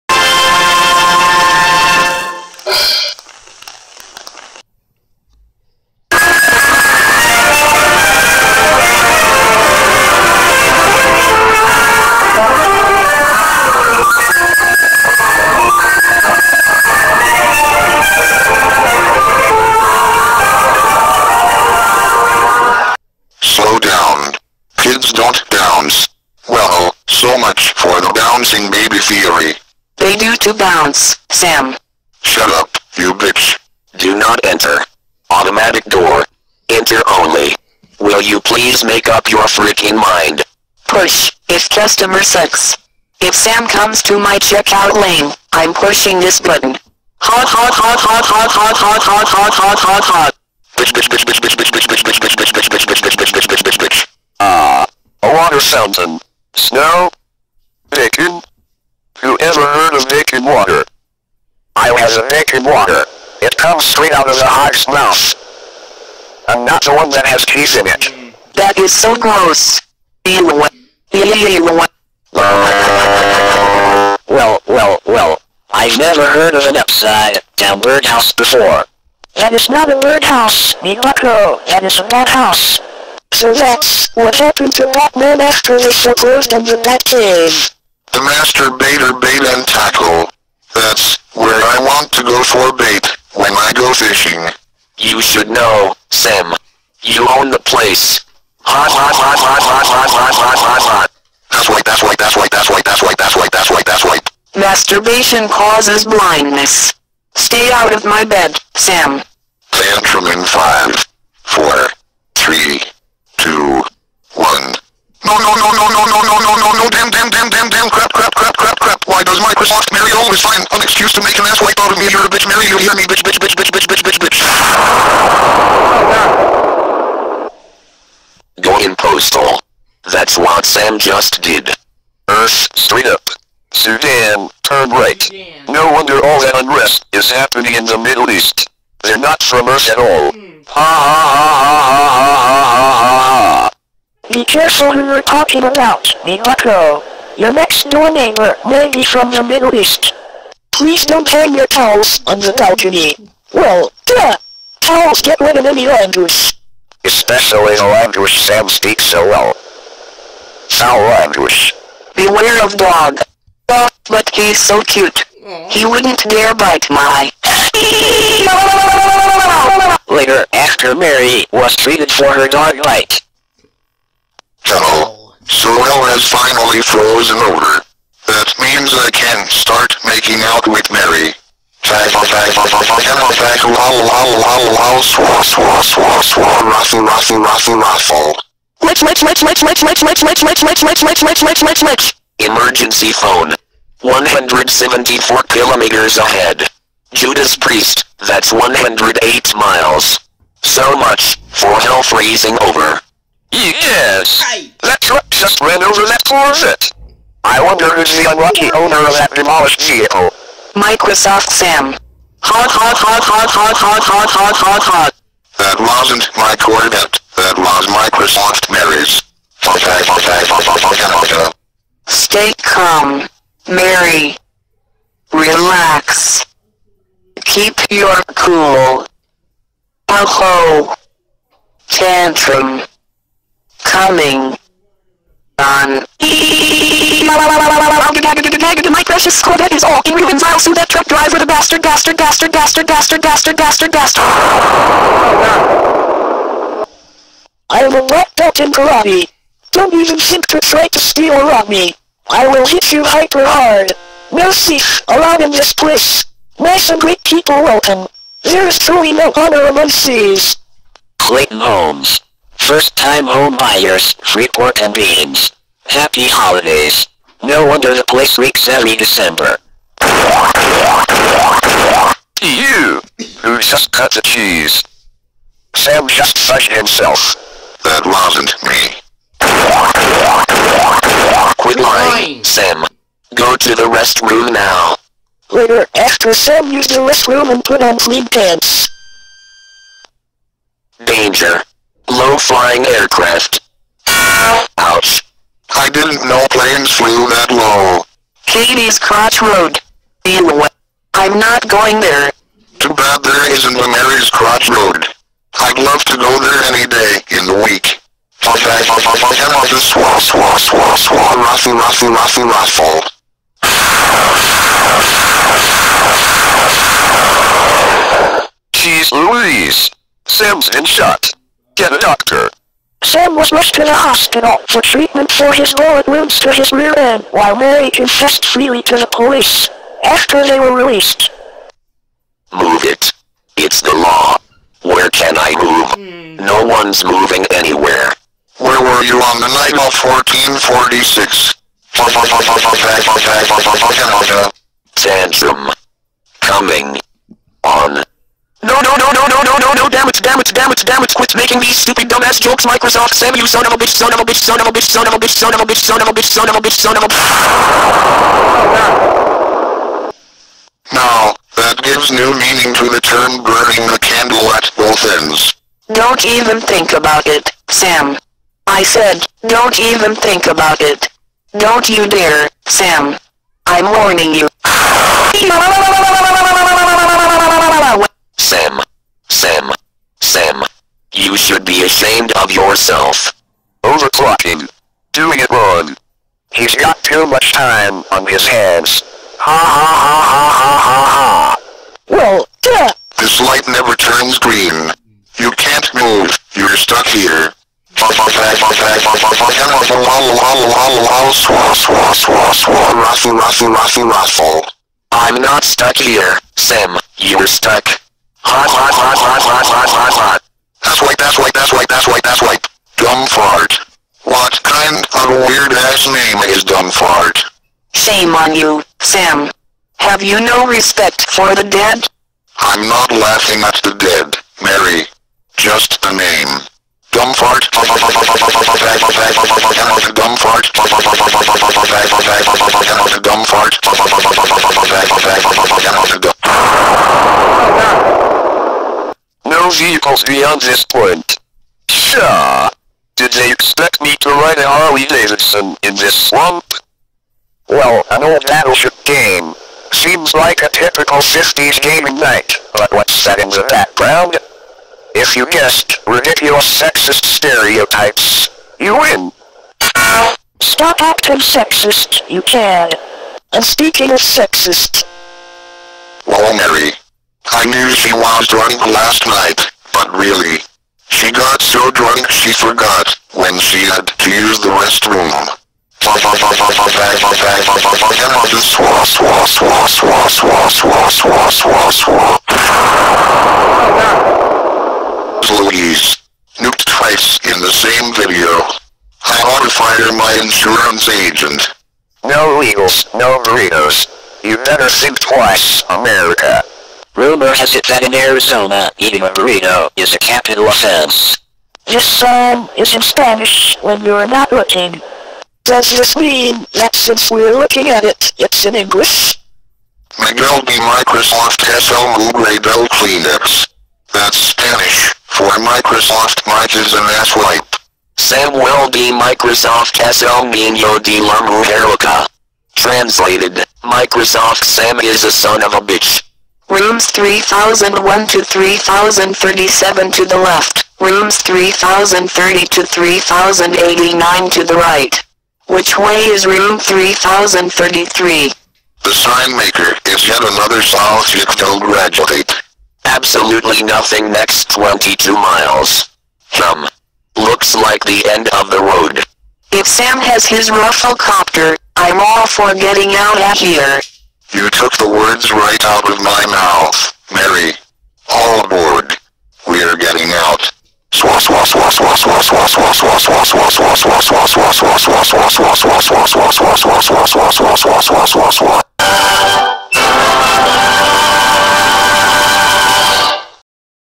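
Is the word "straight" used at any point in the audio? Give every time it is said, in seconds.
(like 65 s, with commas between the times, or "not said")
63 s, 132 s.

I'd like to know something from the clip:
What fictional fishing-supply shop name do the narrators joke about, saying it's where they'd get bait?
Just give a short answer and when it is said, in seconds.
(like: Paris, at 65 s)
The Master Baiter Bait and Tackle, at 88 s.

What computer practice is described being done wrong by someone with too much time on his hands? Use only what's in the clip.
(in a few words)
Overclocking.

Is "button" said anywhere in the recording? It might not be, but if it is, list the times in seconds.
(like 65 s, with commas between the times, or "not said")
46 s.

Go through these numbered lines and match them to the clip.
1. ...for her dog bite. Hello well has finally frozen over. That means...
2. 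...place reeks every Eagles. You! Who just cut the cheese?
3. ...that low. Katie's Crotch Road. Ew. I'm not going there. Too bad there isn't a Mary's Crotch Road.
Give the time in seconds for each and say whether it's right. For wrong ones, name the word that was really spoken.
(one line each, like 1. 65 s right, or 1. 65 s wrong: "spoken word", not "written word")
1. 172 s right
2. 268 s wrong: "December", not "Eagles"
3. 297 s right.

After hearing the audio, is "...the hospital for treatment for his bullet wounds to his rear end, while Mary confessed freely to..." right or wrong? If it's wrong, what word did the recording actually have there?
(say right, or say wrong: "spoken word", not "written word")
right.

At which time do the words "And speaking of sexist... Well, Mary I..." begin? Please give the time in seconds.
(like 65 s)
463 s.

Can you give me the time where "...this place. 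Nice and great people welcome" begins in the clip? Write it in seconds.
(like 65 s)
255 s.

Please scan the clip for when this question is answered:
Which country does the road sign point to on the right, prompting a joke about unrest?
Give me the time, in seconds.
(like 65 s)
133 s.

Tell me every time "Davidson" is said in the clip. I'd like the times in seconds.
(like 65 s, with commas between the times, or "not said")
445 s.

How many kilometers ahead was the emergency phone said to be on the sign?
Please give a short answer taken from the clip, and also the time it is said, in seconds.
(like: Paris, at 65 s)
174, at 194 s.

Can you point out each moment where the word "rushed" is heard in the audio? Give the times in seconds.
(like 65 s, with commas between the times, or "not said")
323 s.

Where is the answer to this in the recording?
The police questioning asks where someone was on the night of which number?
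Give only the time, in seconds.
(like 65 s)
339 s.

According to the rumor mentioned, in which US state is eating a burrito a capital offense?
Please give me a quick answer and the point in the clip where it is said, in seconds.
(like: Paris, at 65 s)
Arizona, at 498 s.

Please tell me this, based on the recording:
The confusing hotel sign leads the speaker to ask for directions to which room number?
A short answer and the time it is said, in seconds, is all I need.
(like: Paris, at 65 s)
3033, at 536 s.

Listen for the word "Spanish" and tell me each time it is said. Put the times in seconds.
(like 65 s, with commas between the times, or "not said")
503 s, 514 s.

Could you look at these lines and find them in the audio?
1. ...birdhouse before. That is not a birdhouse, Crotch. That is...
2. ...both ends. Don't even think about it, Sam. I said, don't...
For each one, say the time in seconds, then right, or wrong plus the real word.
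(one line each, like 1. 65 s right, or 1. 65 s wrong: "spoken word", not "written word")
1. 77 s wrong: "Miyako", not "Crotch"
2. 364 s right.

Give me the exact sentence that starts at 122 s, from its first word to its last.
You're a bitch, Mary, you hear me, bitch, bitch, bitch, bitch, bitch, bitch, bitch, bitch.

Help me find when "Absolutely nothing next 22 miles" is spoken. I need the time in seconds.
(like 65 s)
543 s.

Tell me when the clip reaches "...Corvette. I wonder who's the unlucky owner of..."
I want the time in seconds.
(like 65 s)
206 s.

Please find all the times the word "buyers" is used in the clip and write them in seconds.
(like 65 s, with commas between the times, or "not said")
263 s.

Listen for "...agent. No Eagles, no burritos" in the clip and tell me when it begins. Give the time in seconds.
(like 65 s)
491 s.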